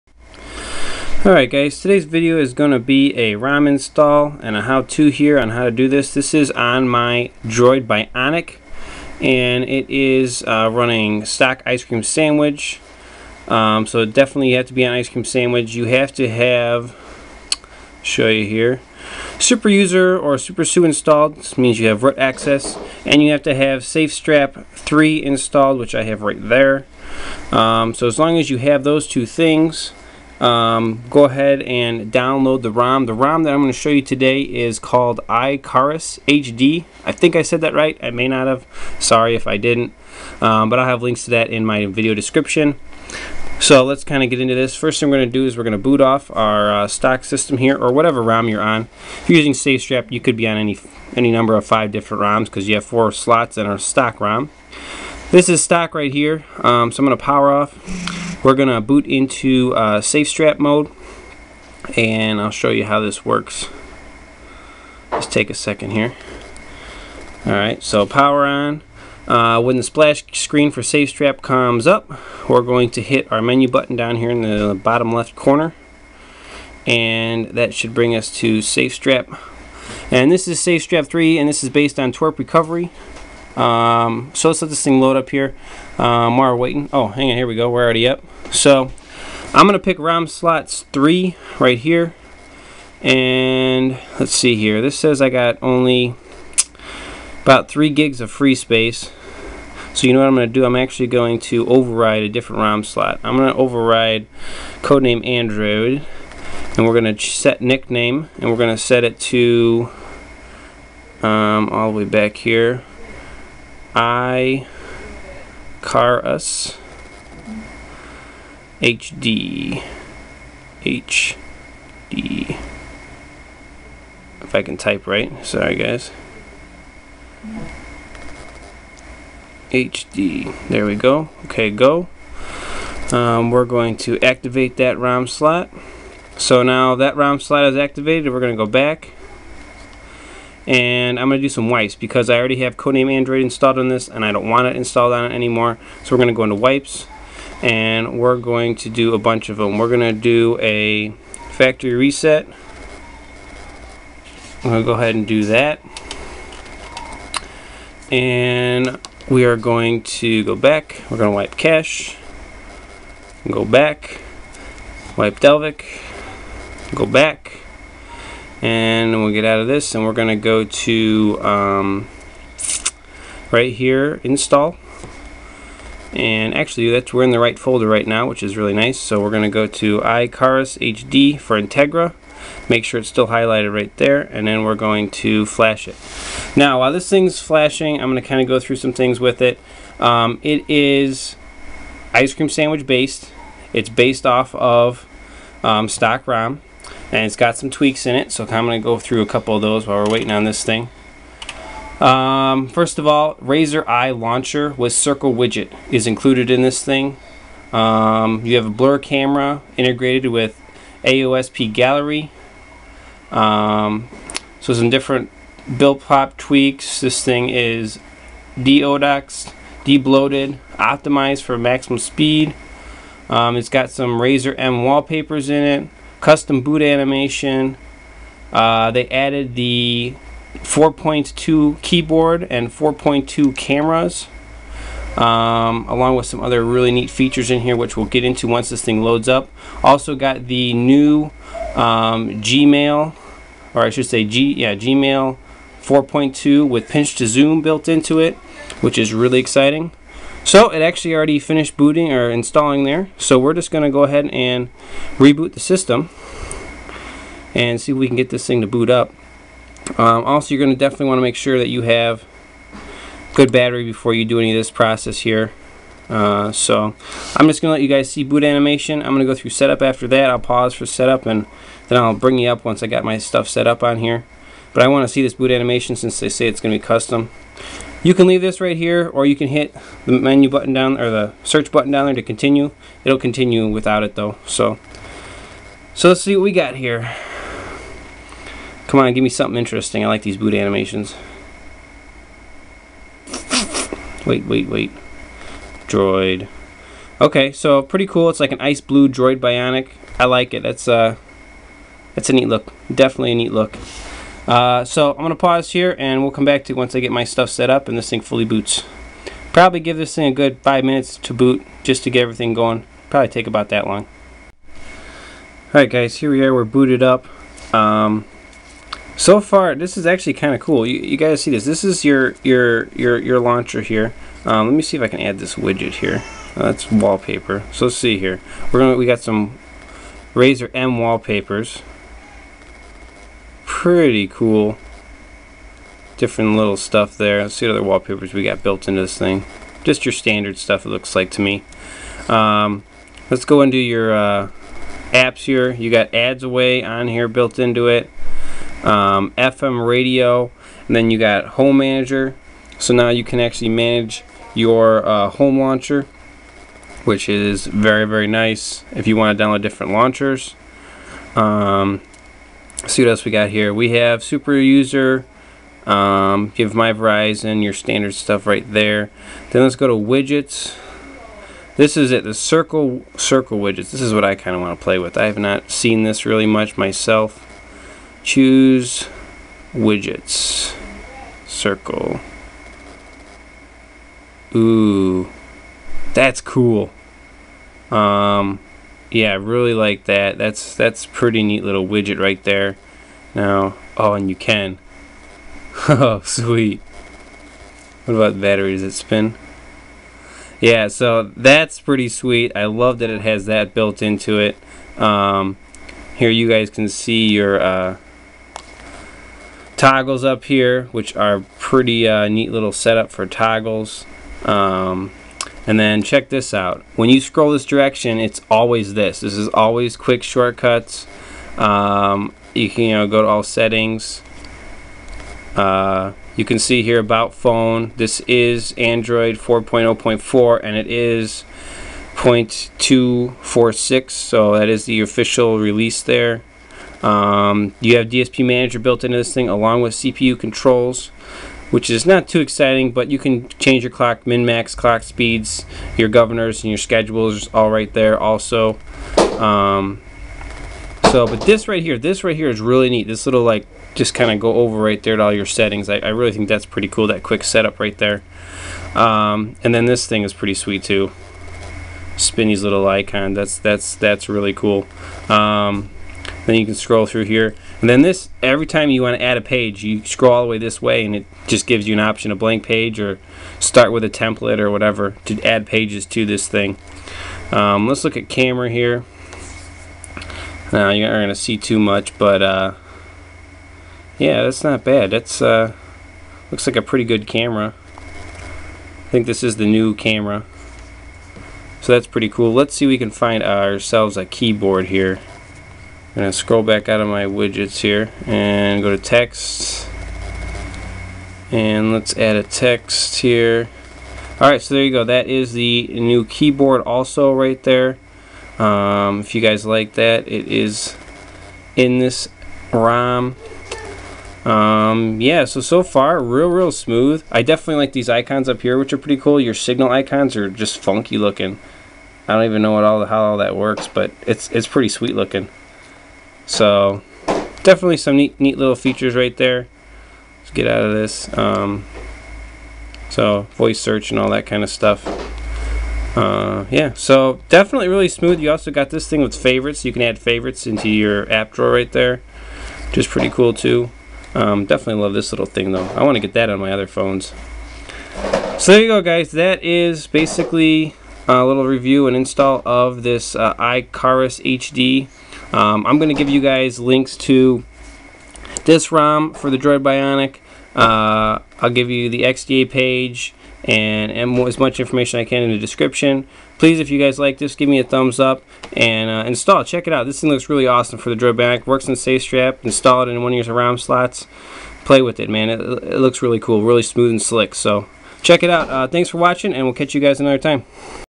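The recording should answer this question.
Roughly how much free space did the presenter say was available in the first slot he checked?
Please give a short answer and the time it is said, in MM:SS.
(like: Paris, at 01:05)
3 gigs, at 01:37.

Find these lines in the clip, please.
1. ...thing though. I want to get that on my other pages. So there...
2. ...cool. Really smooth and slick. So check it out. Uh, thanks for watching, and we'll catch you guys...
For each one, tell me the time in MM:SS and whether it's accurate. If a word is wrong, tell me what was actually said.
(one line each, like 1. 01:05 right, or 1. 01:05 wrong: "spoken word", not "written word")
1. 09:05 wrong: "phones", not "pages"
2. 09:36 right.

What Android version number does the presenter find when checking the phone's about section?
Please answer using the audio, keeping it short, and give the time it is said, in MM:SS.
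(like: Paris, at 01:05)
4.0.4, at 07:09.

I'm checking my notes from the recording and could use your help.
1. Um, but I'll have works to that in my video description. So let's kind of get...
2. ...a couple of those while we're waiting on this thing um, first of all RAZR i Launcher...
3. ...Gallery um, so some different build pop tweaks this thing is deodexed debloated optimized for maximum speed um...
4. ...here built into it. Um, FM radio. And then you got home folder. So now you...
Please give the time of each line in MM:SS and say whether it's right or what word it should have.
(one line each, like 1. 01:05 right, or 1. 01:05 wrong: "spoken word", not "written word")
1. 00:40 wrong: "links", not "works"
2. 03:19 right
3. 03:31 right
4. 05:47 wrong: "manager", not "folder".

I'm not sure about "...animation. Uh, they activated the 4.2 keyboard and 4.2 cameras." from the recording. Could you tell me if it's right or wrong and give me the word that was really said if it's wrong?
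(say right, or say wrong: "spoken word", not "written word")
wrong: "added", not "activated".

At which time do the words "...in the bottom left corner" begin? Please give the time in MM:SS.
01:14.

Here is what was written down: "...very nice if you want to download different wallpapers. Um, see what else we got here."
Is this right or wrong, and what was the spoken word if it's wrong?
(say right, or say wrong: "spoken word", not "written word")
wrong: "launchers", not "wallpapers".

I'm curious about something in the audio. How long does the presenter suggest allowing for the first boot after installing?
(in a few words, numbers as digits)
five minutes.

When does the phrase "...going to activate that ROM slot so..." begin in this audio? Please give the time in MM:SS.
02:13.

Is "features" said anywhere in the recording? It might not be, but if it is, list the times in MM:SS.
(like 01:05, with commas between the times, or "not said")
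03:57, 08:48.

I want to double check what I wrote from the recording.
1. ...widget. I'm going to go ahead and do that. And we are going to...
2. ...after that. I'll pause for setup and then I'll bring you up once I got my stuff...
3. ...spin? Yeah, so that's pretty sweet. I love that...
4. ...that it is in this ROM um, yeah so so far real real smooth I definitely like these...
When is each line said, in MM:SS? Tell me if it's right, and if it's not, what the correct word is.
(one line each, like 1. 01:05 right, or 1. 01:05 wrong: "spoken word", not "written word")
1. 02:31 wrong: "reset", not "widget"
2. 04:29 right
3. 06:38 right
4. 08:29 right.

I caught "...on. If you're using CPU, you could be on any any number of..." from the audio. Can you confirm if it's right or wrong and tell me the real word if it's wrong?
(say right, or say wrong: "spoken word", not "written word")
wrong: "SafeStrap", not "CPU".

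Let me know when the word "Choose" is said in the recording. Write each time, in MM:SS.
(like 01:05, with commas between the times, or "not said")
06:18.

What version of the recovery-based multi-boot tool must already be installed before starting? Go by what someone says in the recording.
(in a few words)
SafeStrap 3.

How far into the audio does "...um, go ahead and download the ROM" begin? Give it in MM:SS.
00:30.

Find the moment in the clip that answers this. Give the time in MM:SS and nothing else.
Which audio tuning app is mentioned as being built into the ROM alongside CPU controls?
07:18.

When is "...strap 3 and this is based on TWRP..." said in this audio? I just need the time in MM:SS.
01:20.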